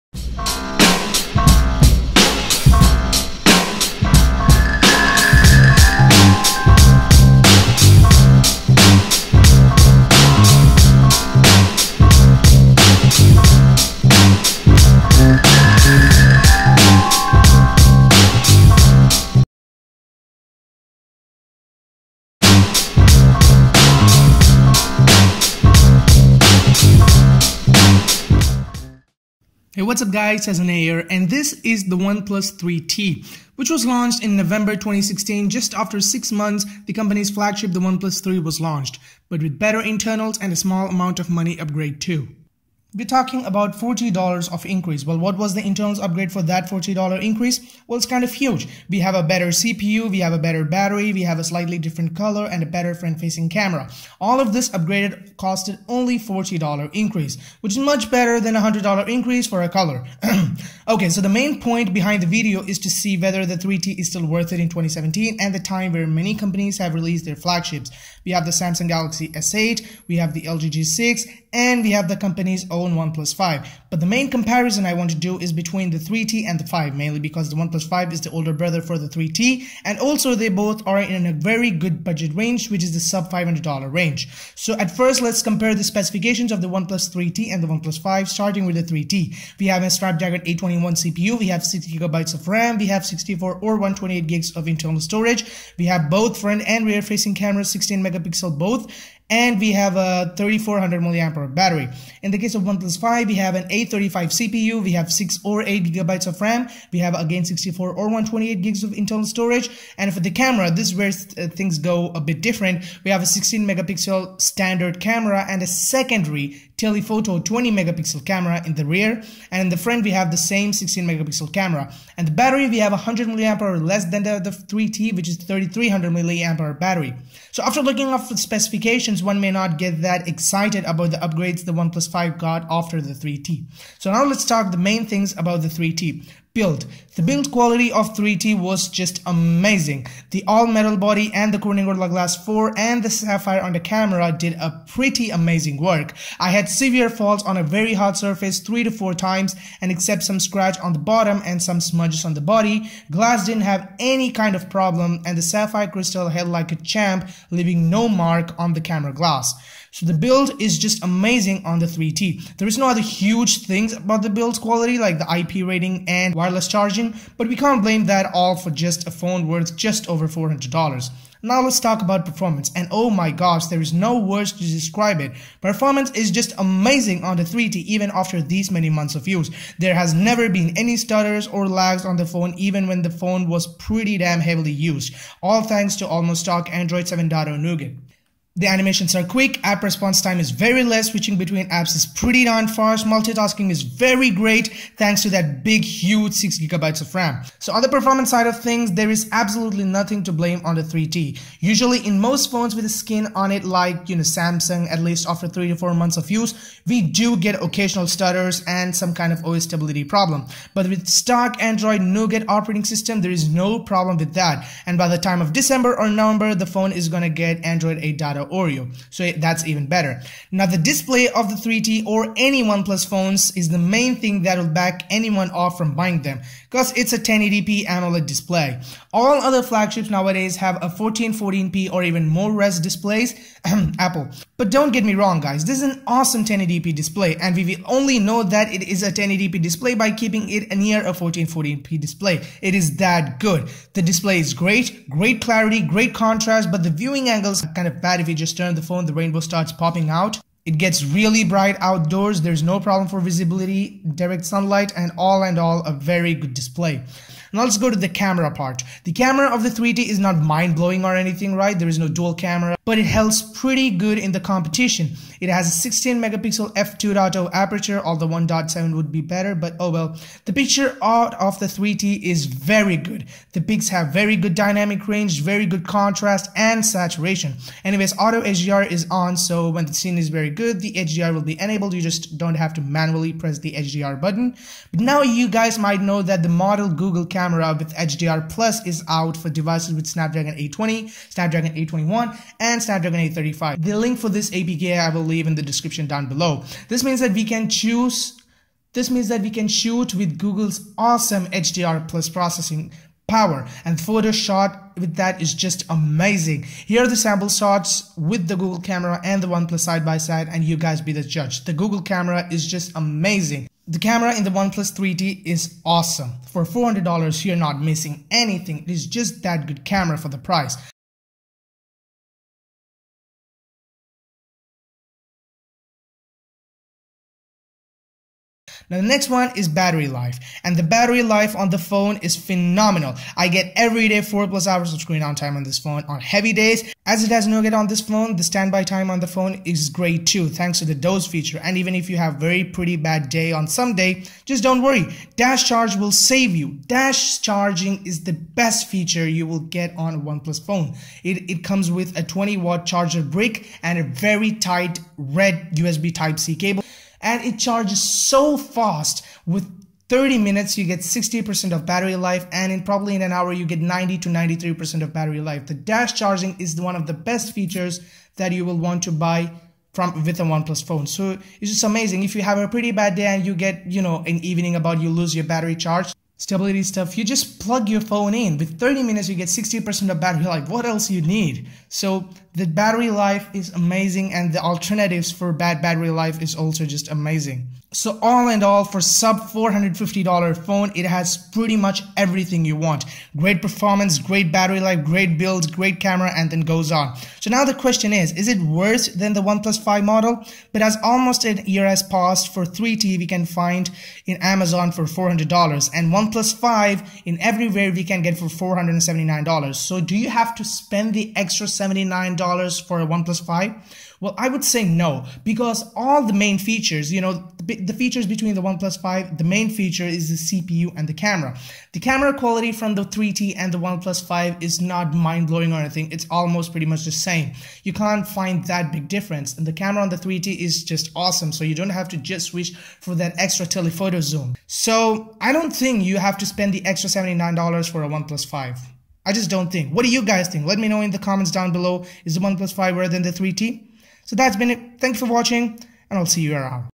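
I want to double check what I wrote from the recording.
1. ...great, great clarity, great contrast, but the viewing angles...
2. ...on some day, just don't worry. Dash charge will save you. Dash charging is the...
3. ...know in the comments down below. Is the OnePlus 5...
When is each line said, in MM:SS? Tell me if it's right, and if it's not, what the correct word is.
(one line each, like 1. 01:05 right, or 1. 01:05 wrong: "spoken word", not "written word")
1. 04:04 right
2. 05:43 right
3. 07:20 right.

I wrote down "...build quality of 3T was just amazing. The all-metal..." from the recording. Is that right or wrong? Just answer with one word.
right.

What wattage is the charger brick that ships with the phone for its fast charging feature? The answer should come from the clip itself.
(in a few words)
20 watts.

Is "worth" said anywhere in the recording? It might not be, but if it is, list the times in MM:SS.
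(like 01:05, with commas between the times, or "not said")
01:04, 02:49.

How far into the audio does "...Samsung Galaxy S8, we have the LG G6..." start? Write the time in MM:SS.
01:08.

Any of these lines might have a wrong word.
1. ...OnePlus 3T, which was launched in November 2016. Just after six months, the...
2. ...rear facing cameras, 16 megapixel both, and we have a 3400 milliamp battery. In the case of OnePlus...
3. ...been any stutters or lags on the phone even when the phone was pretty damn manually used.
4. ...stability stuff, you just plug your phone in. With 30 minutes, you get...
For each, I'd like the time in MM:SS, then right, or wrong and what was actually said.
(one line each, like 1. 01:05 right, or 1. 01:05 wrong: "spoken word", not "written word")
1. 00:31 right
2. 01:36 right
3. 03:00 wrong: "heavily", not "manually"
4. 06:16 right.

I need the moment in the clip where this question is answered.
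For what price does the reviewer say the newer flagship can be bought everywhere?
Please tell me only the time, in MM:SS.
06:48.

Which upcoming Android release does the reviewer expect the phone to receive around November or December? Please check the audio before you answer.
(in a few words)
Android 8.0 Oreo.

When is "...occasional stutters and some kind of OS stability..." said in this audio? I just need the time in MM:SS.
03:27.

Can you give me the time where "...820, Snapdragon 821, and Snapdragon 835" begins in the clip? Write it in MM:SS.
04:50.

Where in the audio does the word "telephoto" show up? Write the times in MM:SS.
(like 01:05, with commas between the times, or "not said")
01:56, 07:13.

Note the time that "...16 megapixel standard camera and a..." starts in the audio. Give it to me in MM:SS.
01:53.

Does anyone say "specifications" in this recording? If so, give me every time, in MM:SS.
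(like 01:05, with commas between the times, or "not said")
01:25, 02:08.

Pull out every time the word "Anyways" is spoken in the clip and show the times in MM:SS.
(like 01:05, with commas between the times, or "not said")
04:37.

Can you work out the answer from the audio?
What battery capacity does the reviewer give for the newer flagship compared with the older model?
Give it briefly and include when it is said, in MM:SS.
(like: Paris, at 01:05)
3300 mAh, at 02:05.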